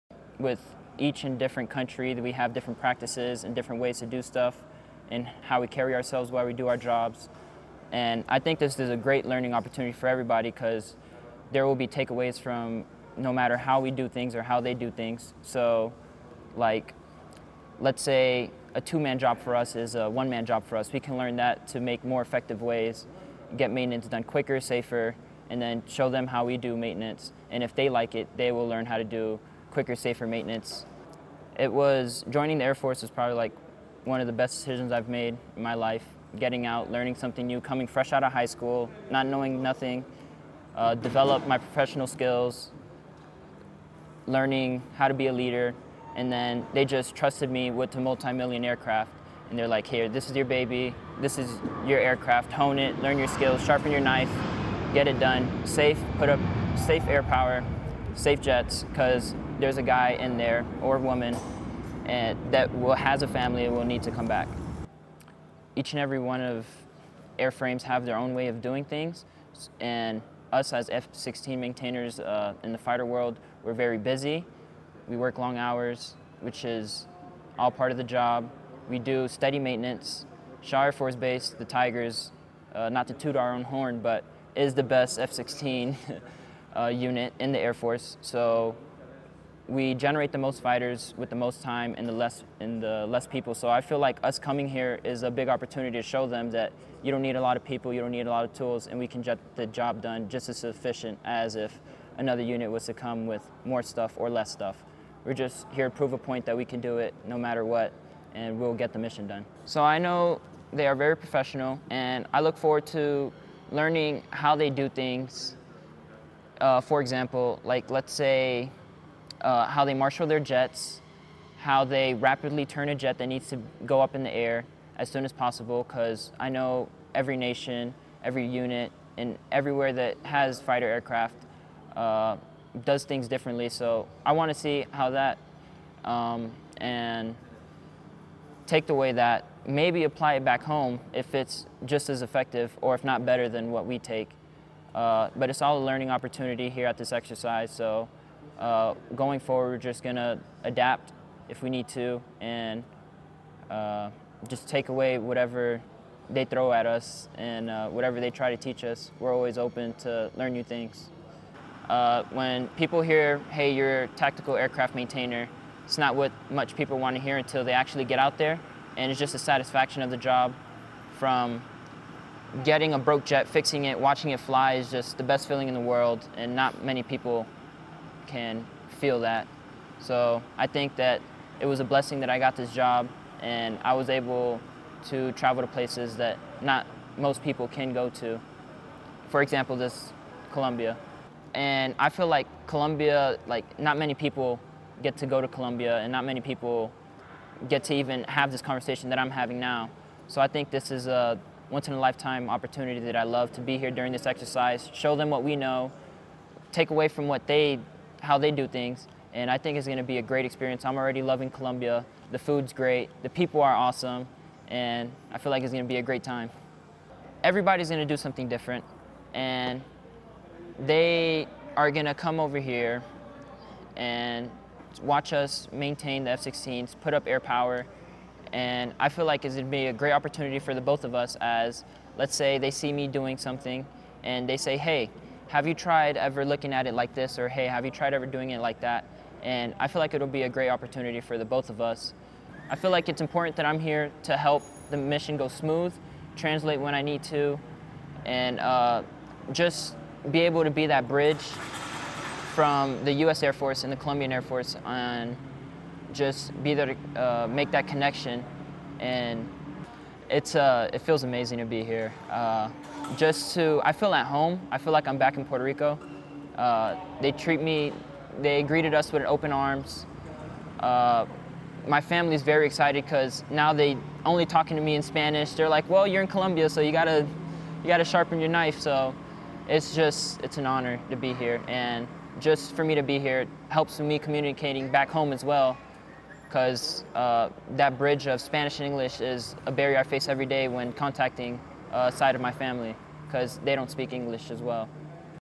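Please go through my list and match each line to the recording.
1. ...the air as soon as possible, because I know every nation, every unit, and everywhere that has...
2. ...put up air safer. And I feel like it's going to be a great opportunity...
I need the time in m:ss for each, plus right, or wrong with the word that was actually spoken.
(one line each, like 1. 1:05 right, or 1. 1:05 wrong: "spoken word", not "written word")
1. 2:04 right
2. 3:47 wrong: "power", not "safer".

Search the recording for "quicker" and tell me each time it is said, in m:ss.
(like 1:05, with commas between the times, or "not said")
0:24, 0:29.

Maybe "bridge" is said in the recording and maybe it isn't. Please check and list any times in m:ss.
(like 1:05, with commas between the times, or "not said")
4:11, 4:47.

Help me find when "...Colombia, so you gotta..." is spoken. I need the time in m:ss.
4:36.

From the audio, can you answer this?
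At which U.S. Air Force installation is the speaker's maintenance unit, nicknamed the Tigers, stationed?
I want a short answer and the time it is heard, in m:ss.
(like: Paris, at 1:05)
Shaw Air Force Base, at 1:20.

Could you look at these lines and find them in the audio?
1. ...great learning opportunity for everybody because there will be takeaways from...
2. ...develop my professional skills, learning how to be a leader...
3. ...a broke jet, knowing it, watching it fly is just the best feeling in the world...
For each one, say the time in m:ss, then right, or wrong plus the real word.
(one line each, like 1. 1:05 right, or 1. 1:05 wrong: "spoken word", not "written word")
1. 0:08 right
2. 0:40 right
3. 2:52 wrong: "fixing", not "knowing".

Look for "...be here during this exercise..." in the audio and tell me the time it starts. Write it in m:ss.
3:23.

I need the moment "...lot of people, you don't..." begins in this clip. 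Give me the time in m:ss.
1:37.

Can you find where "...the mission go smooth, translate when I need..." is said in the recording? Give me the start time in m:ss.
4:04.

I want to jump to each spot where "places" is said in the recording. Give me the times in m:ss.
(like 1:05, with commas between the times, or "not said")
3:05.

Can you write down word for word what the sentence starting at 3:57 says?
Or hey, have you tried ever doing it like that?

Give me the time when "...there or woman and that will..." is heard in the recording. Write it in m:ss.
1:00.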